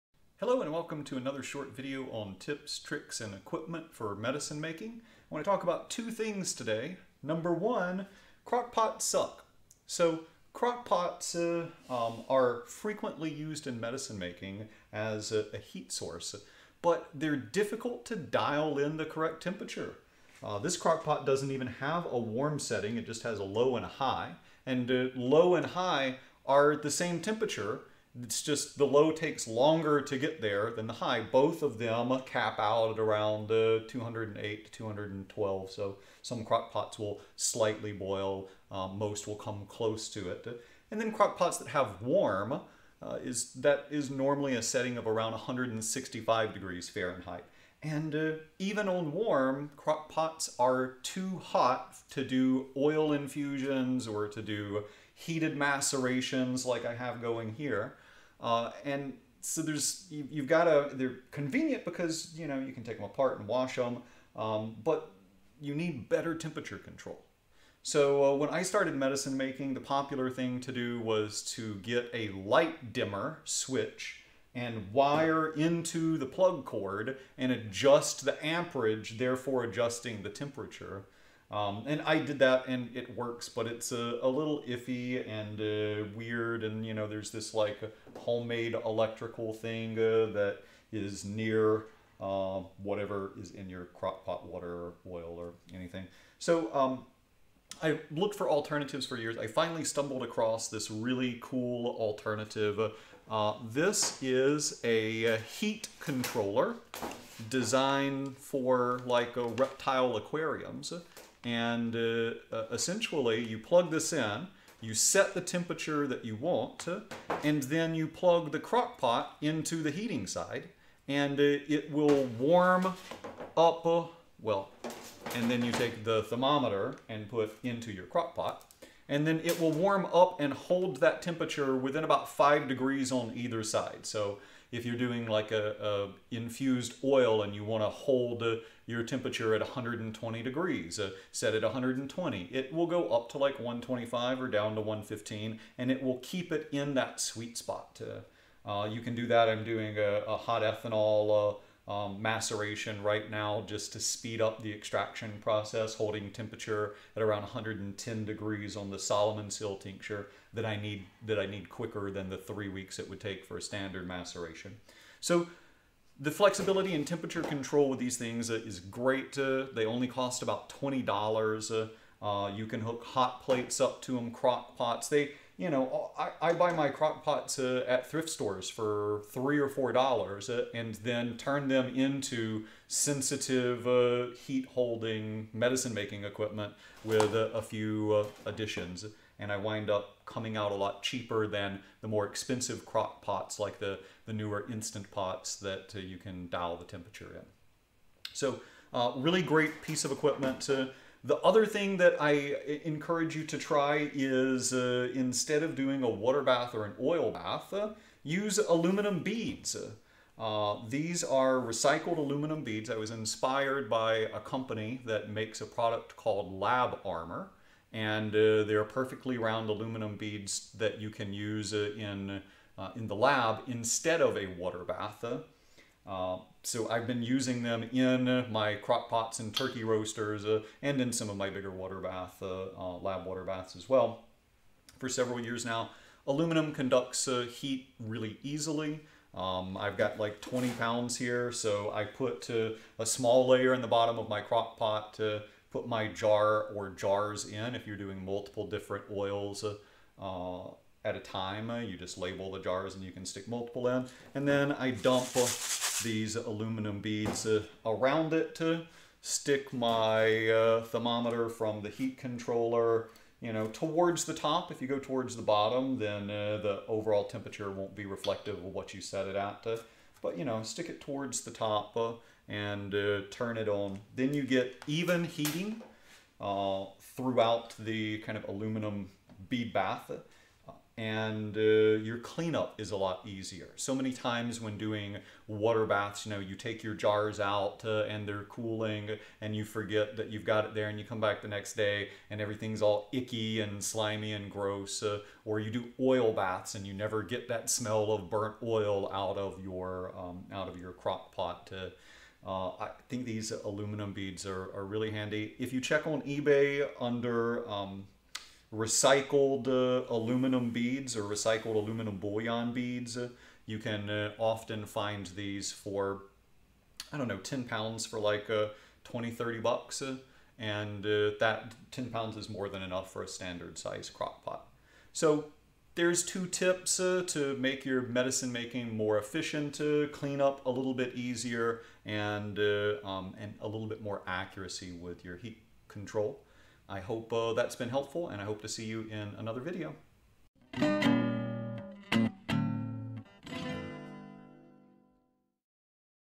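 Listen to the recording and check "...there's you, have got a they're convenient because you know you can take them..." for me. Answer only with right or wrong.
right.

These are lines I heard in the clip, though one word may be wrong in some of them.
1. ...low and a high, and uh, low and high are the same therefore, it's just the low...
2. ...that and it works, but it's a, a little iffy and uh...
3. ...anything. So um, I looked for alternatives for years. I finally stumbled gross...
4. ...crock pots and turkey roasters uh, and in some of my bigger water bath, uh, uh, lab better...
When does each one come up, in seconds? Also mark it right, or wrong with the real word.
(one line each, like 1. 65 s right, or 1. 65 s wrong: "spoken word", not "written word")
1. 23 s wrong: "temperature", not "therefore"
2. 82 s right
3. 95 s wrong: "across", not "gross"
4. 228 s wrong: "water", not "better".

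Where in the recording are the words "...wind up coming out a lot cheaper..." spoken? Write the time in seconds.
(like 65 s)
189 s.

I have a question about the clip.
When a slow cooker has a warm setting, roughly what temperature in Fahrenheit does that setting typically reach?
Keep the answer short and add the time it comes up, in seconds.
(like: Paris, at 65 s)
165 degrees, at 45 s.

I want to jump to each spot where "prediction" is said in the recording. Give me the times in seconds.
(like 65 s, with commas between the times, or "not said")
not said.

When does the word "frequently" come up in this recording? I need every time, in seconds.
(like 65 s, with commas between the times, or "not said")
12 s.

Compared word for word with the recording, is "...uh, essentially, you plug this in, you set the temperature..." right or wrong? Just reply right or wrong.
right.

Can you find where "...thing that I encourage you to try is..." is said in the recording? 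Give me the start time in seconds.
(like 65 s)
201 s.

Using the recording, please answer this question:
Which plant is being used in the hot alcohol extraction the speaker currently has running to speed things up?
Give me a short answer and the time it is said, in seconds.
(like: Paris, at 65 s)
Solomon seal, at 158 s.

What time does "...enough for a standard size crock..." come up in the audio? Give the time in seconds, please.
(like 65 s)
322 s.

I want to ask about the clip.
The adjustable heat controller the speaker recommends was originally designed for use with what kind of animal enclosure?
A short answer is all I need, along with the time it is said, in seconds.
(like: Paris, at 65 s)
reptile aquariums, at 109 s.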